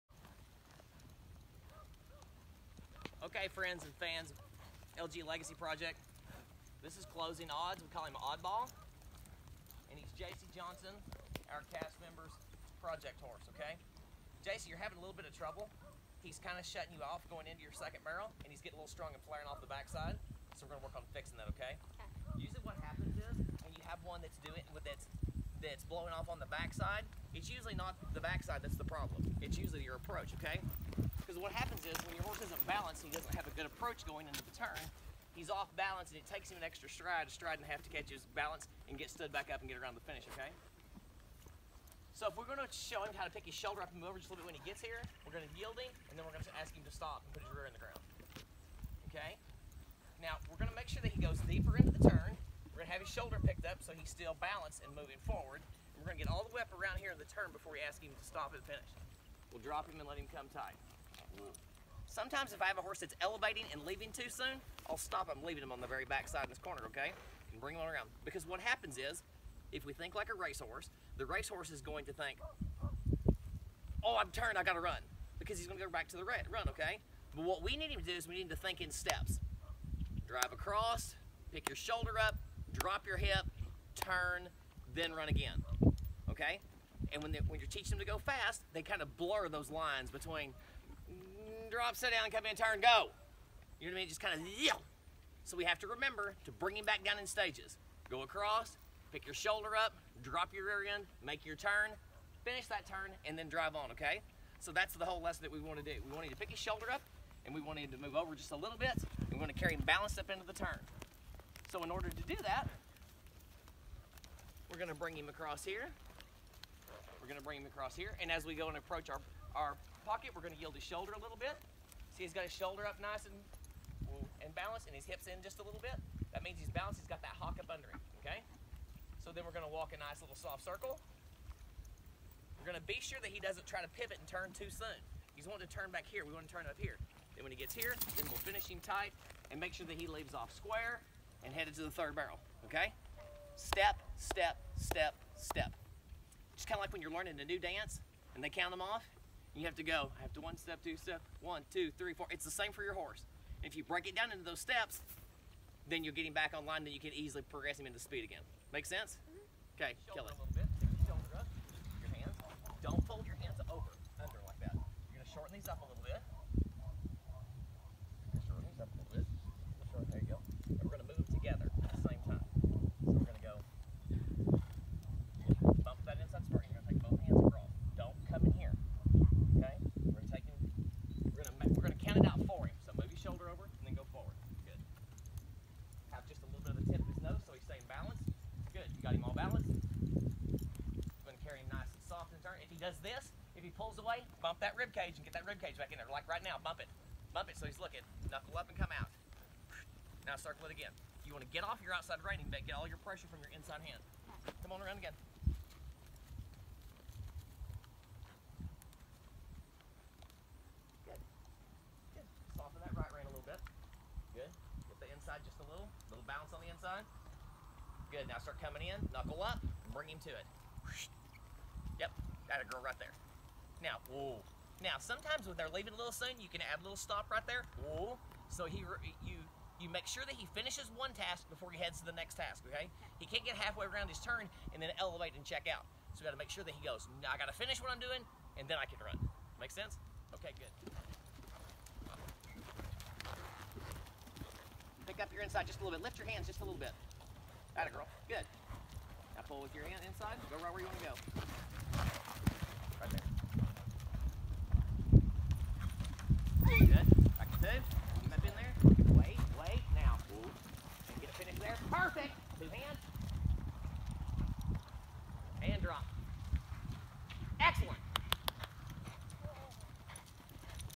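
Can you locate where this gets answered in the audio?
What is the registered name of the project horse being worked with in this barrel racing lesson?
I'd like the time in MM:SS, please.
00:07.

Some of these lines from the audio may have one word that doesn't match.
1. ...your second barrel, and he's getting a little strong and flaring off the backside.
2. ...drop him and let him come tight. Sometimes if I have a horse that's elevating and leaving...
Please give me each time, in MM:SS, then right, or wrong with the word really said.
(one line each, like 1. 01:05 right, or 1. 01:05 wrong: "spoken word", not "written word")
1. 00:17 right
2. 00:59 right.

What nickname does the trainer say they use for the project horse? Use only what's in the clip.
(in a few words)
Oddball.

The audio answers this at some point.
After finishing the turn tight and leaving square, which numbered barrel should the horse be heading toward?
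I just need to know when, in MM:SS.
02:21.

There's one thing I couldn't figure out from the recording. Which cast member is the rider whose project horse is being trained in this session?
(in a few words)
Jaycie Johnson.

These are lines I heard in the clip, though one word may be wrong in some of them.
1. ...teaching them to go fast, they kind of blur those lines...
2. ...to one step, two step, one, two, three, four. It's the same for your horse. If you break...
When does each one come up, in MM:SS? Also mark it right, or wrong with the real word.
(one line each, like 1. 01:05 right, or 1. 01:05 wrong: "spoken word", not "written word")
1. 01:27 right
2. 02:30 right.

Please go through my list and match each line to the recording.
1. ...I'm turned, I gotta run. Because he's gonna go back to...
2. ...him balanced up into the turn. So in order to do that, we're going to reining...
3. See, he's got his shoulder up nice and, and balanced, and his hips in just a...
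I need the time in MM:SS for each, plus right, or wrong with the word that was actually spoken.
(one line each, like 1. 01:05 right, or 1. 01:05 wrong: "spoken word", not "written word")
1. 01:14 right
2. 01:49 wrong: "bring", not "reining"
3. 02:02 right.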